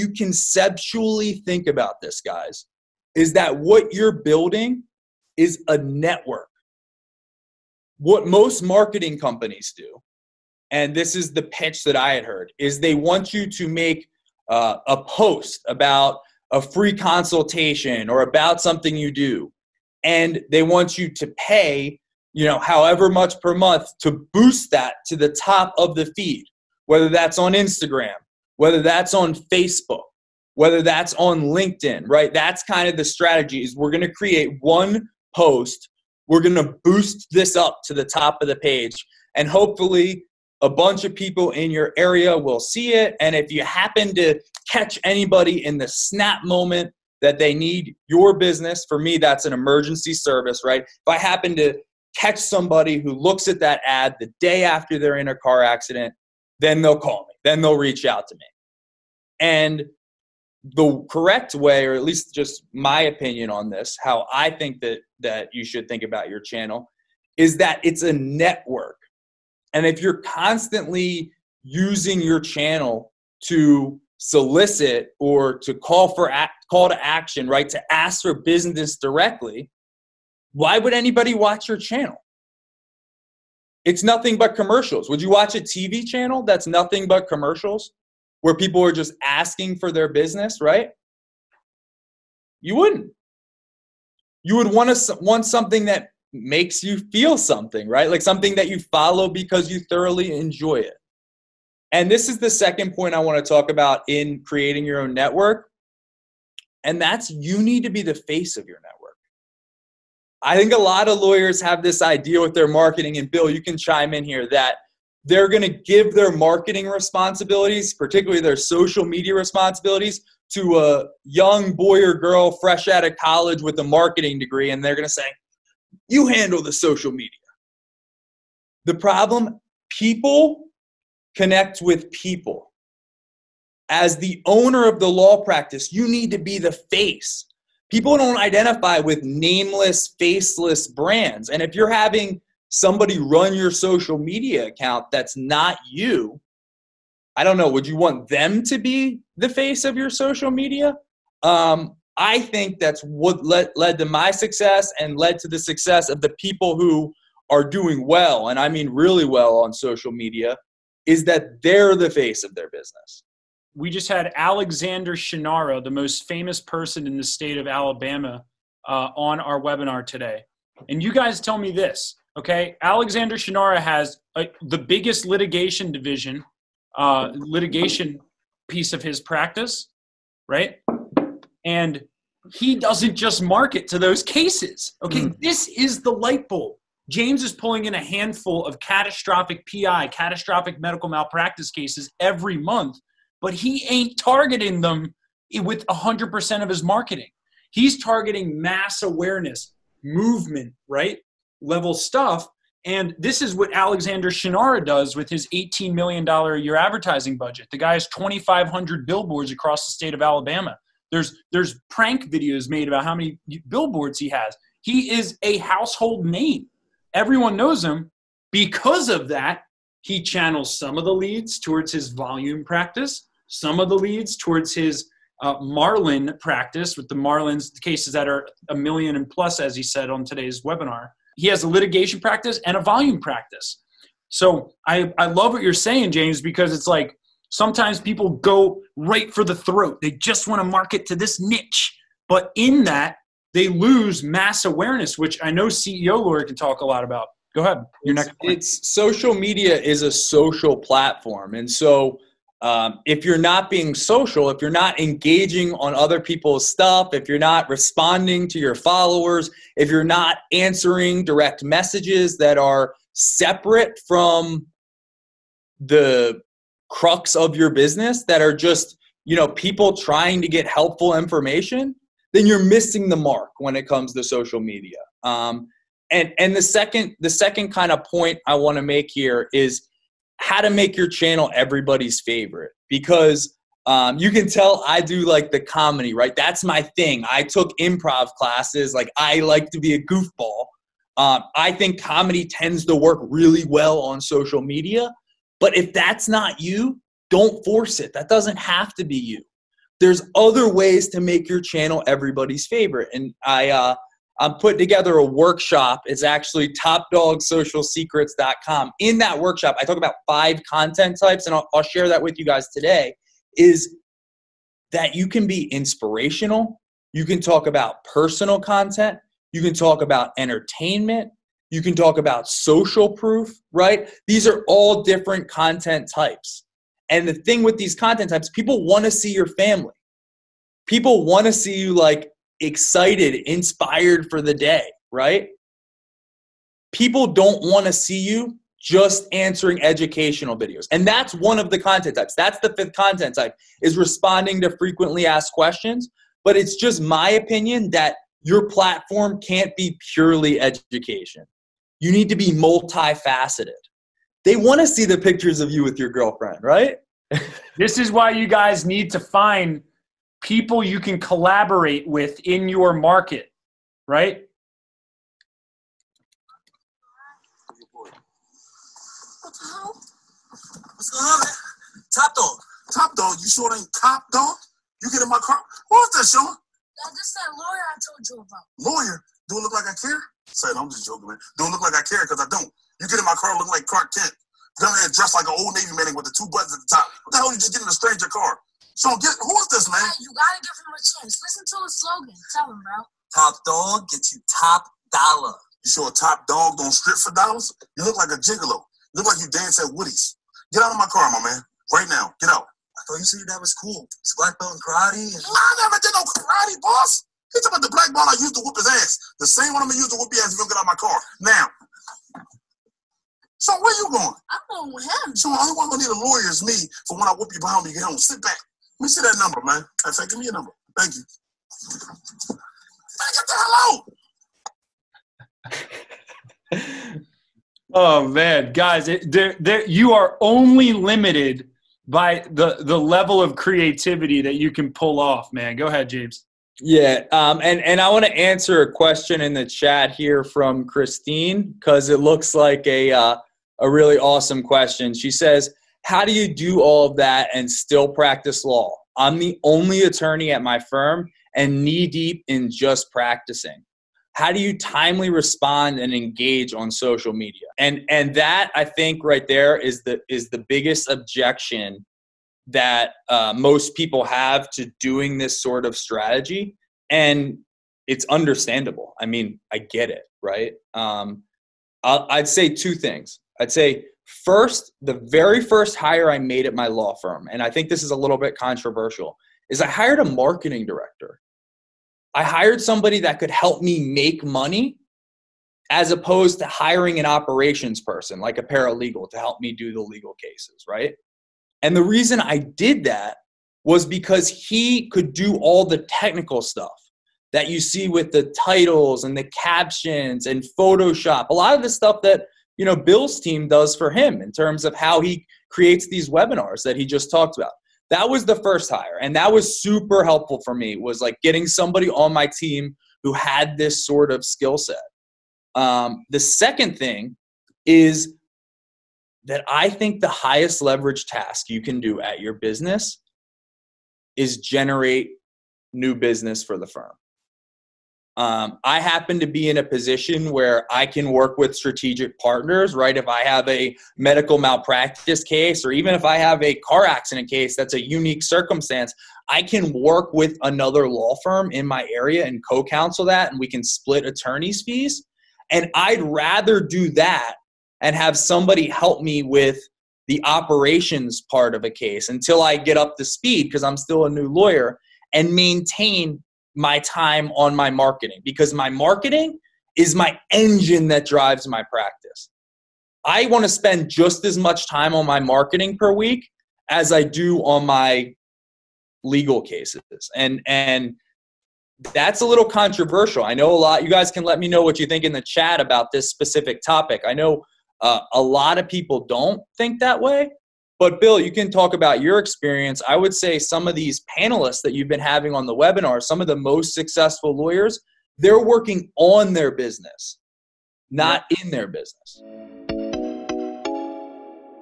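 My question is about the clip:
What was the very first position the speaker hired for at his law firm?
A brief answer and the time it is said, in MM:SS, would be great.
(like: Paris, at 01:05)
Marketing director, at 08:00.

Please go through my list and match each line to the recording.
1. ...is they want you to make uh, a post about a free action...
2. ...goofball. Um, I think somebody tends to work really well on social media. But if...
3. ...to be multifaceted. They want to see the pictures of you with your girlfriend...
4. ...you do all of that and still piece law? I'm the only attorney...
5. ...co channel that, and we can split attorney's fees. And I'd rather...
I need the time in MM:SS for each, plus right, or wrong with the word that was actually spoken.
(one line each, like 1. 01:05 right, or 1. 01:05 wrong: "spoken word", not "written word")
1. 00:12 wrong: "consultation", not "action"
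2. 04:50 wrong: "comedy", not "somebody"
3. 05:52 right
4. 07:26 wrong: "practice", not "piece"
5. 09:02 wrong: "counsel", not "channel".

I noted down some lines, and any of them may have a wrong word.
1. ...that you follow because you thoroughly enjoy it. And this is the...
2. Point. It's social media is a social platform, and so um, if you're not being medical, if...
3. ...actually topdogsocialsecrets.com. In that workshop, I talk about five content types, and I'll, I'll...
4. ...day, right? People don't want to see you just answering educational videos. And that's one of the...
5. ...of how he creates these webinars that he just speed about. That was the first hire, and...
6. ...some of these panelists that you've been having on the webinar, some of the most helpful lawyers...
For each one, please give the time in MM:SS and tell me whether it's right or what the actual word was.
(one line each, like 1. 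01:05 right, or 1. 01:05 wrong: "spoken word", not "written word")
1. 01:38 right
2. 04:08 wrong: "social", not "medical"
3. 05:06 right
4. 05:34 right
5. 08:24 wrong: "talked", not "speed"
6. 09:43 wrong: "successful", not "helpful".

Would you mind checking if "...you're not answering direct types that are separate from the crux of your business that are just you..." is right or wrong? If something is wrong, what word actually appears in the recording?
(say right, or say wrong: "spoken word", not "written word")
wrong: "messages", not "types".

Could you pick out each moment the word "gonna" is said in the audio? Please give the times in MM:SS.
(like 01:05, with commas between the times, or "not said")
06:49, 06:55.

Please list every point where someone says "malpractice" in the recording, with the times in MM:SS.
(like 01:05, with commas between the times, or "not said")
03:11, 08:54.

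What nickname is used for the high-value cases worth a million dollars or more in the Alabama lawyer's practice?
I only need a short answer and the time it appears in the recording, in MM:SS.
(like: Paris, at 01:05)
Marlins, at 03:47.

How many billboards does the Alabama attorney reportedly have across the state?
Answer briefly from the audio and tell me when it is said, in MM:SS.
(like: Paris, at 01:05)
2,500, at 03:28.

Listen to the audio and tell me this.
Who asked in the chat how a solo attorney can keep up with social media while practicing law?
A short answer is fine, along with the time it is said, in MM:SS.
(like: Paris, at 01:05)
Christine, at 07:20.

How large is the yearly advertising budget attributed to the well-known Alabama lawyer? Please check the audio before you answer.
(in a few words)
$18 million.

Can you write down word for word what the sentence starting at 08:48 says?
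Um, I happen to be in a position where I can work with strategic partners, right?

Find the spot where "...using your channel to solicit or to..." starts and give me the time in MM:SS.
01:11.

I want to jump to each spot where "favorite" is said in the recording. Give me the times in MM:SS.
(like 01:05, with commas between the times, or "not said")
04:42, 05:02.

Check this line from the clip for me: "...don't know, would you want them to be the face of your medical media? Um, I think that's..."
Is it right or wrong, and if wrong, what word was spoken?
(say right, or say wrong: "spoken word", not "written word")
wrong: "social", not "medical".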